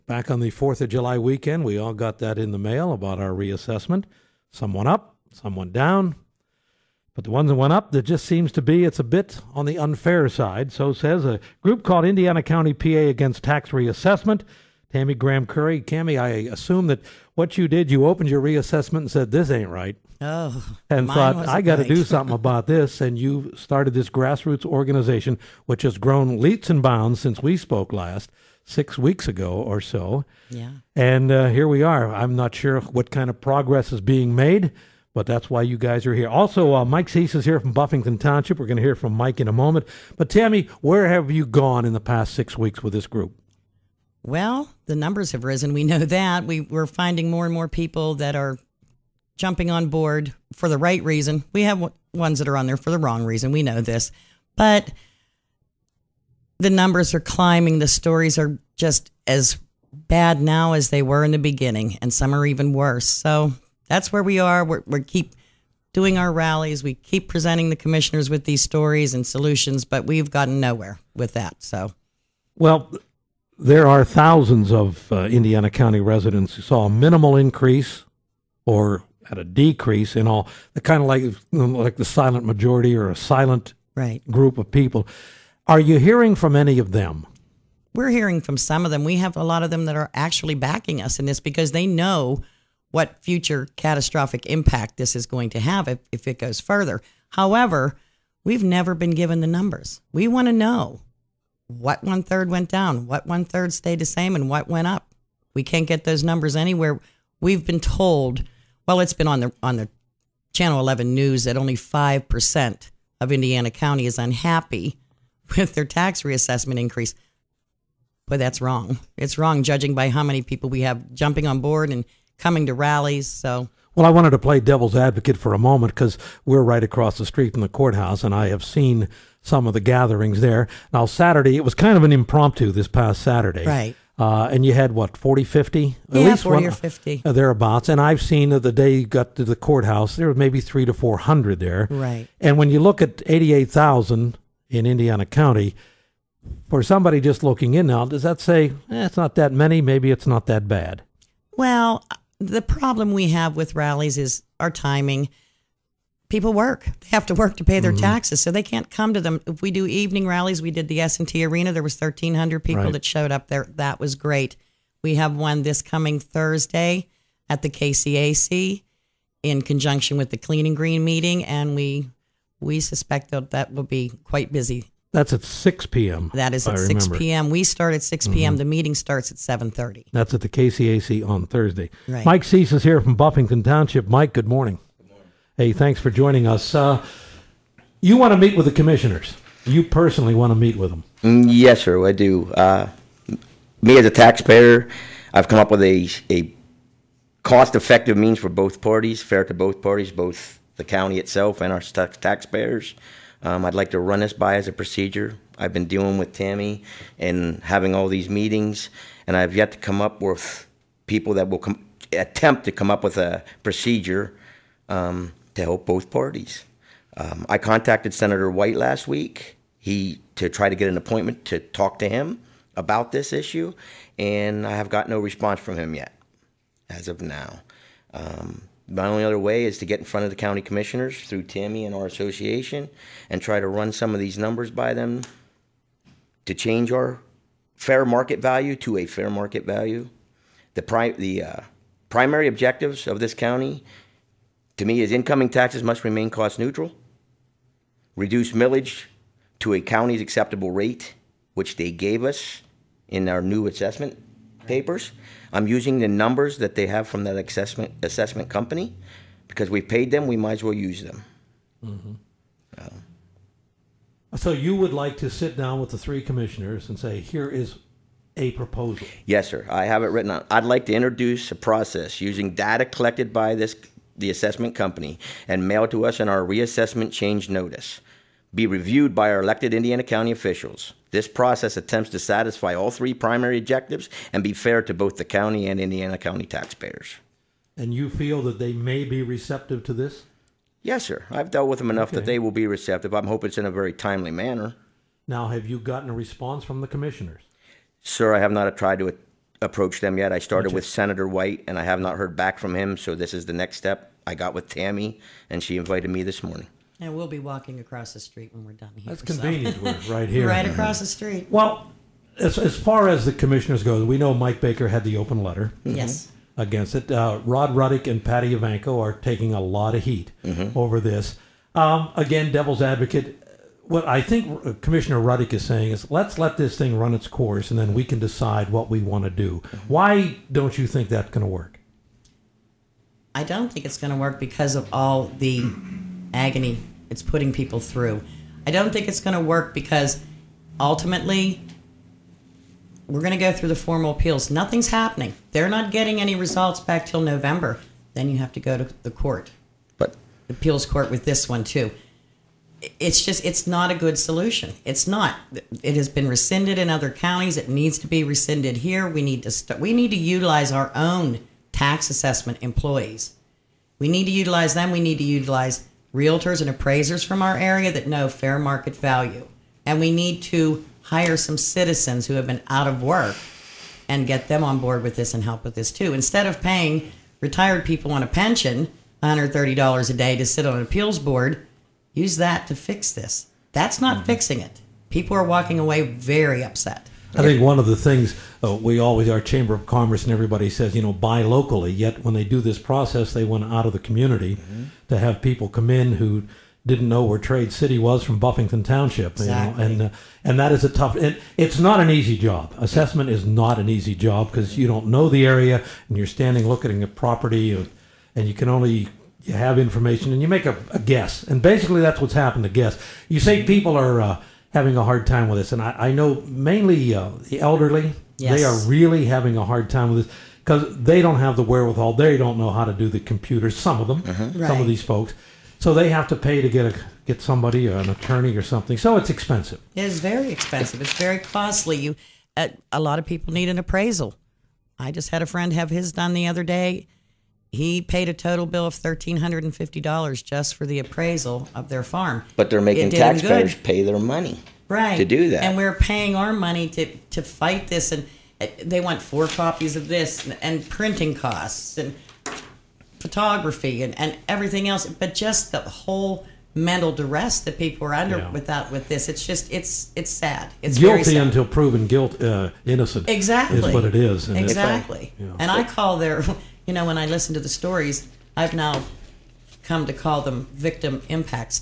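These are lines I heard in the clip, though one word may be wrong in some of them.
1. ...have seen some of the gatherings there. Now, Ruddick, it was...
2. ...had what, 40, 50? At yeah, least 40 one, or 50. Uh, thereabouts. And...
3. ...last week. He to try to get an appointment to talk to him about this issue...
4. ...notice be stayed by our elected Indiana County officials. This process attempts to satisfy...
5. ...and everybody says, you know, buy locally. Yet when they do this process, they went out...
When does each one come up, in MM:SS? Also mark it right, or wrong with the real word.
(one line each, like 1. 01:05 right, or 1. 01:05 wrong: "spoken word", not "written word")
1. 02:08 wrong: "Saturday", not "Ruddick"
2. 02:14 right
3. 03:38 right
4. 04:37 wrong: "reviewed", not "stayed"
5. 06:30 right.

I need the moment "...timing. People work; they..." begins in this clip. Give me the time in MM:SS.
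02:34.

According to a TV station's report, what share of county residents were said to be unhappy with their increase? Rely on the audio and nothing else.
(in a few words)
5 percent.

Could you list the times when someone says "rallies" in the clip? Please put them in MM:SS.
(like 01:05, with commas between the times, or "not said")
01:06, 02:02, 02:33, 02:40.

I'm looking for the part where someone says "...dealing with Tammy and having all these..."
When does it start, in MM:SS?
03:25.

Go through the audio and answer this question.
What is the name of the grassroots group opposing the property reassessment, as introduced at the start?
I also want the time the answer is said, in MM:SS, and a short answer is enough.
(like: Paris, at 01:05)
Indiana County PA Against Tax Reassessment, at 00:12.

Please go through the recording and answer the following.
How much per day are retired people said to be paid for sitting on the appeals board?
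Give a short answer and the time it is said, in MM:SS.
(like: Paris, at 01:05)
$130, at 06:19.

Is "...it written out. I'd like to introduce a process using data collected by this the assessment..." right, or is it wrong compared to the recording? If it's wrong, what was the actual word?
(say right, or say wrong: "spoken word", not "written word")
right.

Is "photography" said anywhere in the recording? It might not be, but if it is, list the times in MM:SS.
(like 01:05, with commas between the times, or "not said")
07:33.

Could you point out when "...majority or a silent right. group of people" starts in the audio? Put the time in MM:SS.
01:22.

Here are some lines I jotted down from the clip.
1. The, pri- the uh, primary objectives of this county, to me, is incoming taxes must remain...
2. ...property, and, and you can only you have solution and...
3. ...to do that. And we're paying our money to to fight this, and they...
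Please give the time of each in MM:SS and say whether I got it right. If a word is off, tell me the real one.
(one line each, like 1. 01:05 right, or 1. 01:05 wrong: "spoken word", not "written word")
1. 04:00 right
2. 06:47 wrong: "information", not "solution"
3. 07:25 right.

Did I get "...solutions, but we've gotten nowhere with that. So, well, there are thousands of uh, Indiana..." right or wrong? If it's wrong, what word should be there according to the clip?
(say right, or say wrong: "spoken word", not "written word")
right.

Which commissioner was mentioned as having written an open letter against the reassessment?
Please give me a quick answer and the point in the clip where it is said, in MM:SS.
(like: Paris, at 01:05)
Mike Baker, at 05:14.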